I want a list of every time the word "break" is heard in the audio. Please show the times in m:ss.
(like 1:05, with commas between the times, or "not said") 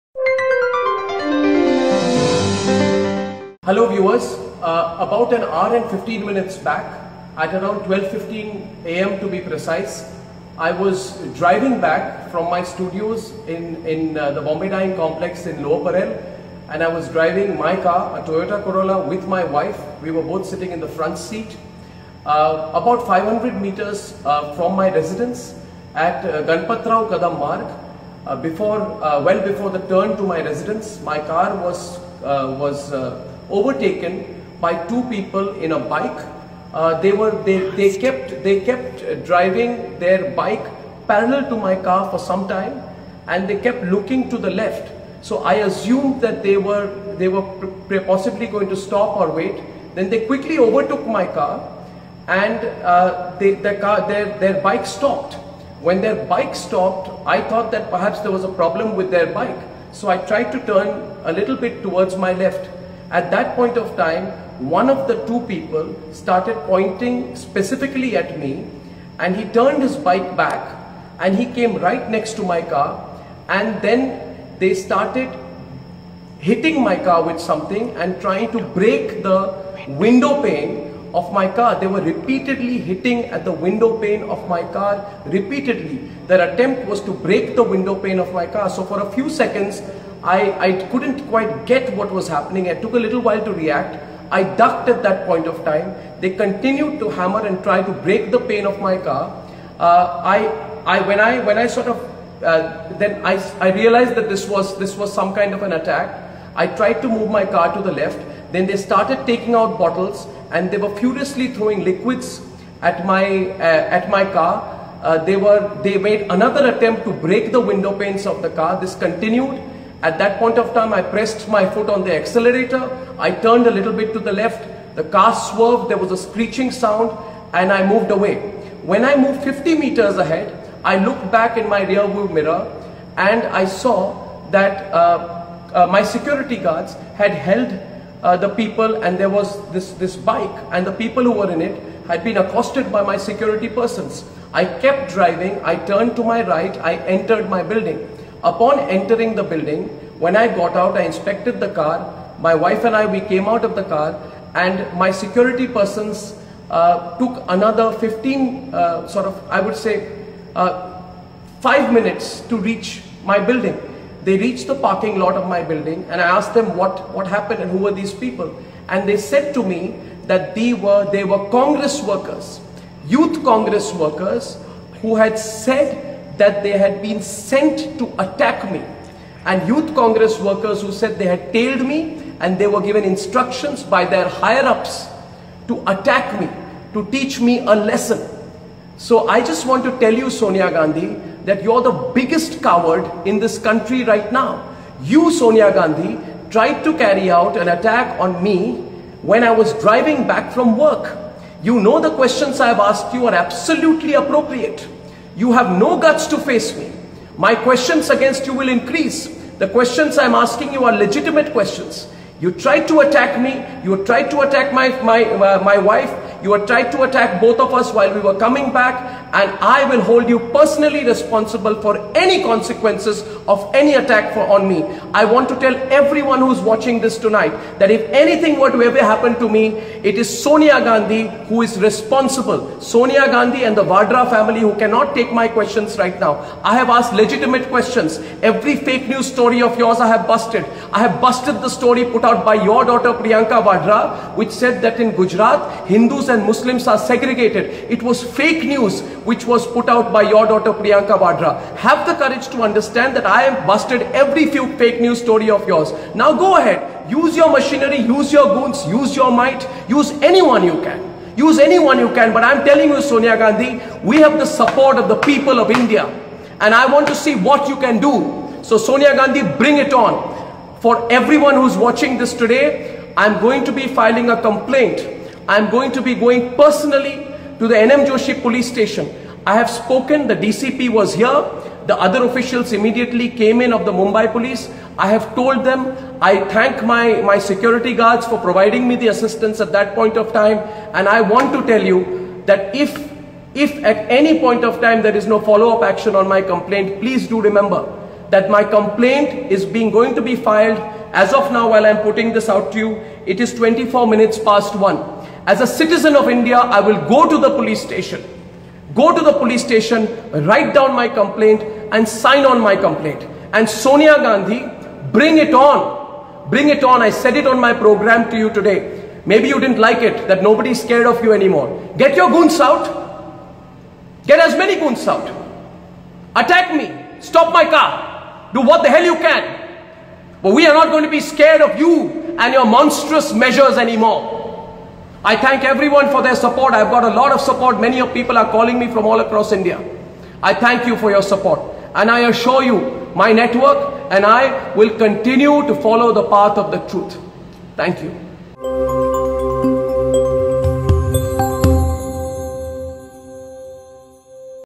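1:18, 1:27, 1:37, 1:57.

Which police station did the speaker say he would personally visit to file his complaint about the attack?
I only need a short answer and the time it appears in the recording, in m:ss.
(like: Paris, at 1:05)
NM Joshi police station, at 4:37.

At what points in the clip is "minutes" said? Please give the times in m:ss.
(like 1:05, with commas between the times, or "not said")
0:06, 2:41, 5:04.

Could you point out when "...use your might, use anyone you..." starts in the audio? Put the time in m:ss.
4:18.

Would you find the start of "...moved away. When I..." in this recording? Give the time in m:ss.
2:07.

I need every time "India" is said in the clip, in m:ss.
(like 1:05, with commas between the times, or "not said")
4:25, 5:06, 5:39.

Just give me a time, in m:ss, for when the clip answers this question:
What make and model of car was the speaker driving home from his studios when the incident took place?
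0:18.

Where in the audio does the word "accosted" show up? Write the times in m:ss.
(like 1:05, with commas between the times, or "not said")
2:22.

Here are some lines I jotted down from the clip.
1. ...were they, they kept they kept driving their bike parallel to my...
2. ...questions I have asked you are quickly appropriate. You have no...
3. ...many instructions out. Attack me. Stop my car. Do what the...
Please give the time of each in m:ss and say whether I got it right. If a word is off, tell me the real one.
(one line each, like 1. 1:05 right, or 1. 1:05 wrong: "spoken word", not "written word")
1. 0:37 right
2. 3:22 wrong: "absolutely", not "quickly"
3. 5:24 wrong: "goons", not "instructions".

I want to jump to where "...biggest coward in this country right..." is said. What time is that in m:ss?
3:12.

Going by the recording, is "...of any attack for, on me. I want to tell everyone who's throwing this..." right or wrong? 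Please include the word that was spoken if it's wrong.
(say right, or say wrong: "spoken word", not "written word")
wrong: "watching", not "throwing".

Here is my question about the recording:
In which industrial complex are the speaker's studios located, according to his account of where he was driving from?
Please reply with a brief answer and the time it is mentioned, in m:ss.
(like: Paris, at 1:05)
Bombay Dyeing Complex, at 0:14.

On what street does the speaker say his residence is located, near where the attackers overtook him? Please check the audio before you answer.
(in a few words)
Ganpatrao Kadam Marg.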